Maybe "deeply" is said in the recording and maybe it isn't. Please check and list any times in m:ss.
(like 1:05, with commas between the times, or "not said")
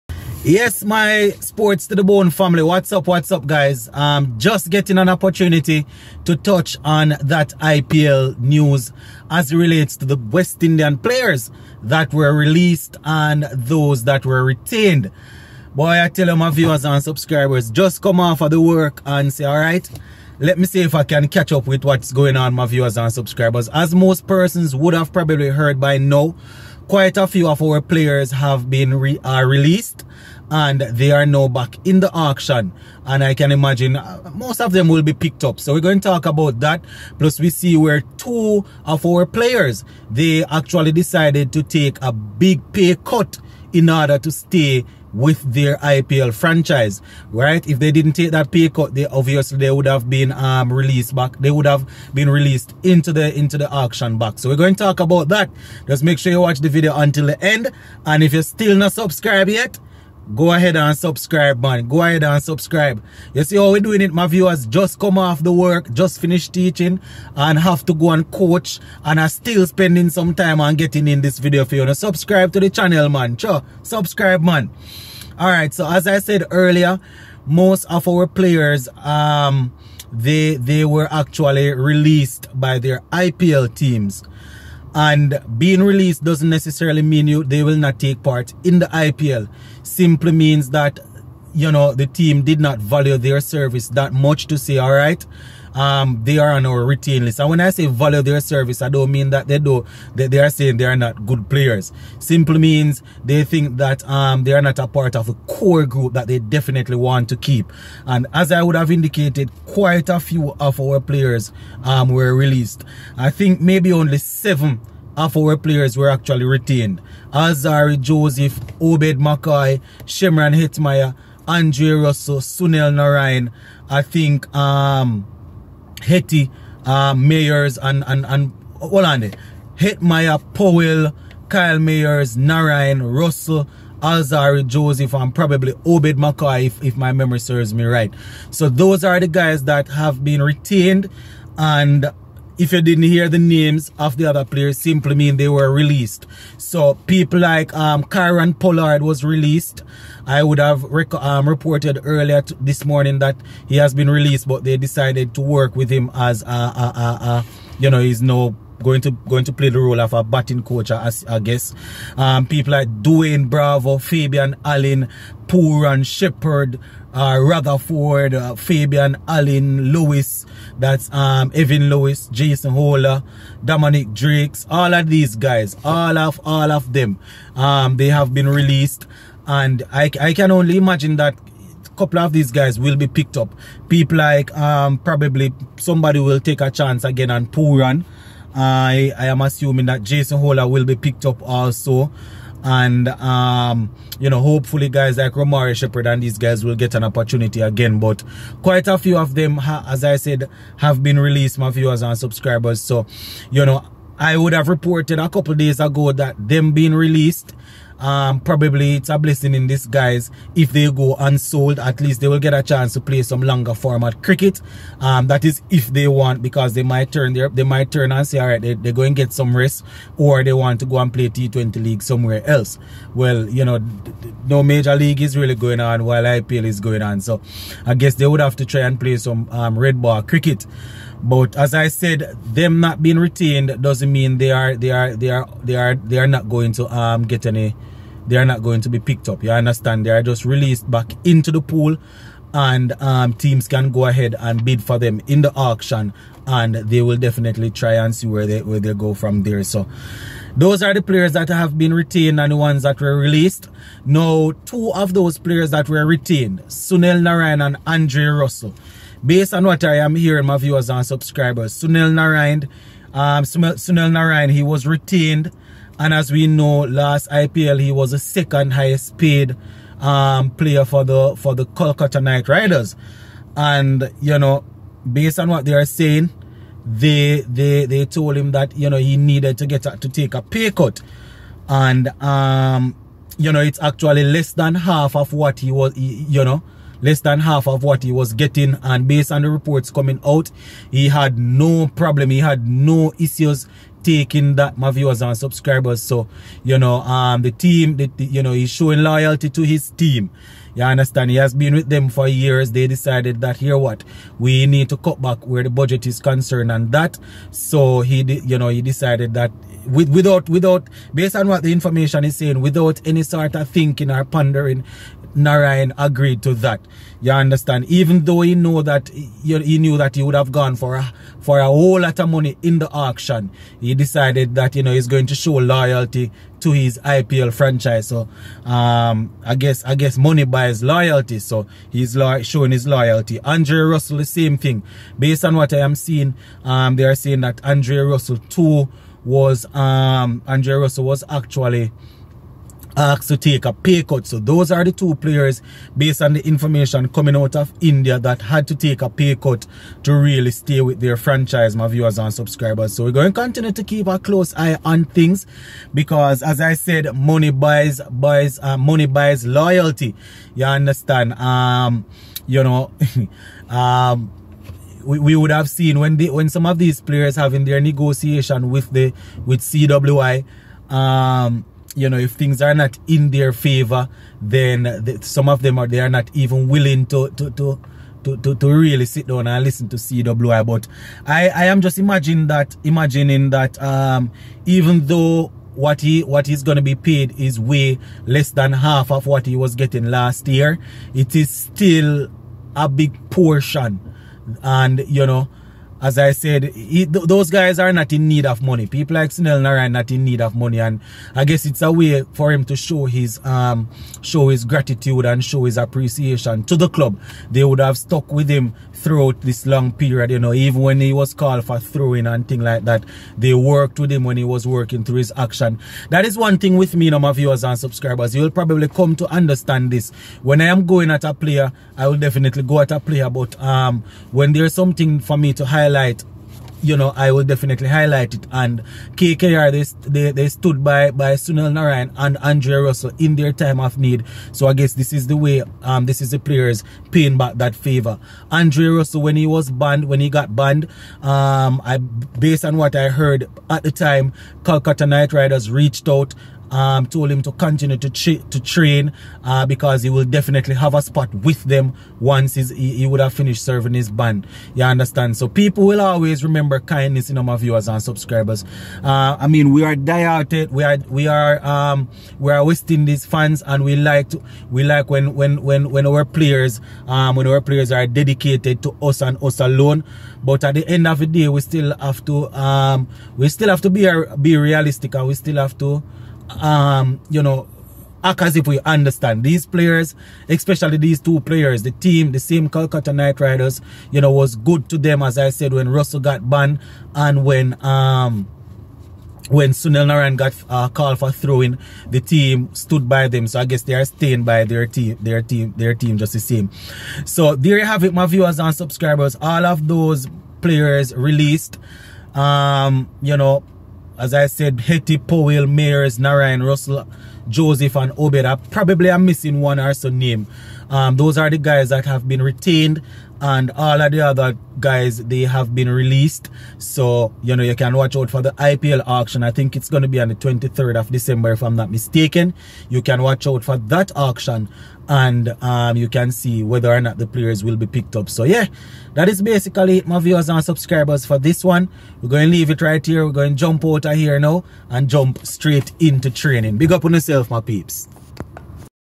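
not said.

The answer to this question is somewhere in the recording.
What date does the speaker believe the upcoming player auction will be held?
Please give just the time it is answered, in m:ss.
8:40.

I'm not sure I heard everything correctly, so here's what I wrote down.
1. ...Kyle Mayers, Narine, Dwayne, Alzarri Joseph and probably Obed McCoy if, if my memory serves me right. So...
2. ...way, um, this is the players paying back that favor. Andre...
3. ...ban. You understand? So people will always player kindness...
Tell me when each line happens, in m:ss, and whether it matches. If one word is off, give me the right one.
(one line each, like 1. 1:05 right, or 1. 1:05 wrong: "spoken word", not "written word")
1. 2:11 wrong: "Russell", not "Dwayne"
2. 7:15 right
3. 7:34 wrong: "remember", not "player".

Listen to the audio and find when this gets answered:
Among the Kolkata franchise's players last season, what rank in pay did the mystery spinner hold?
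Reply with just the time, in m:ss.
4:28.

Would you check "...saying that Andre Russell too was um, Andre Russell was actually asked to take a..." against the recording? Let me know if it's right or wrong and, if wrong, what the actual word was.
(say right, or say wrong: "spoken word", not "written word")
right.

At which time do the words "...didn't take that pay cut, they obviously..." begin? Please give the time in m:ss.
0:47.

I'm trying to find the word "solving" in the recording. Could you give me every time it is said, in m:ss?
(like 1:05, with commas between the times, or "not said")
not said.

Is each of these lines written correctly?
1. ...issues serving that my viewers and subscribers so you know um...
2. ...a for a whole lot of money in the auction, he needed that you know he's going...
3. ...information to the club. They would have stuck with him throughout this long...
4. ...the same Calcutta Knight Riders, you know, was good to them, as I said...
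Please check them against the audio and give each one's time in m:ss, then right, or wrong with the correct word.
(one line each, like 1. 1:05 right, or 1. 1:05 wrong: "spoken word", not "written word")
1. 4:53 wrong: "taking", not "serving"
2. 5:20 wrong: "decided", not "needed"
3. 6:45 wrong: "appreciation", not "information"
4. 8:02 right.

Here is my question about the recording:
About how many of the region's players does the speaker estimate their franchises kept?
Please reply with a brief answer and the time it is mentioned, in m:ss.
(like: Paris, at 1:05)
7, at 1:54.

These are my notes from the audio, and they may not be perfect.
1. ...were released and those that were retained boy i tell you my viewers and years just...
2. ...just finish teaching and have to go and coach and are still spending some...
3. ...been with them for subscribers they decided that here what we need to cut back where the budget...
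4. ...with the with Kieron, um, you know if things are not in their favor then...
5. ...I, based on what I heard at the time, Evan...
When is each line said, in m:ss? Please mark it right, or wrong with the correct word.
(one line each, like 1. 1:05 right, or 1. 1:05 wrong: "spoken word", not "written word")
1. 0:12 wrong: "subscribers", not "years"
2. 1:05 right
3. 5:01 wrong: "years", not "subscribers"
4. 6:08 wrong: "CWI", not "Kieron"
5. 7:21 wrong: "Calcutta", not "Evan".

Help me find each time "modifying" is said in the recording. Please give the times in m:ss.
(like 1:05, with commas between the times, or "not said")
not said.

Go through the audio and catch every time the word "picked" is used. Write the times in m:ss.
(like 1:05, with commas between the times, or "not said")
0:35, 3:03, 3:10, 3:58, 8:47.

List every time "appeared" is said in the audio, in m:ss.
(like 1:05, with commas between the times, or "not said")
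not said.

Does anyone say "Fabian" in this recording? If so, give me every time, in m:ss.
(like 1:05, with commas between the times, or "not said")
2:43, 2:48.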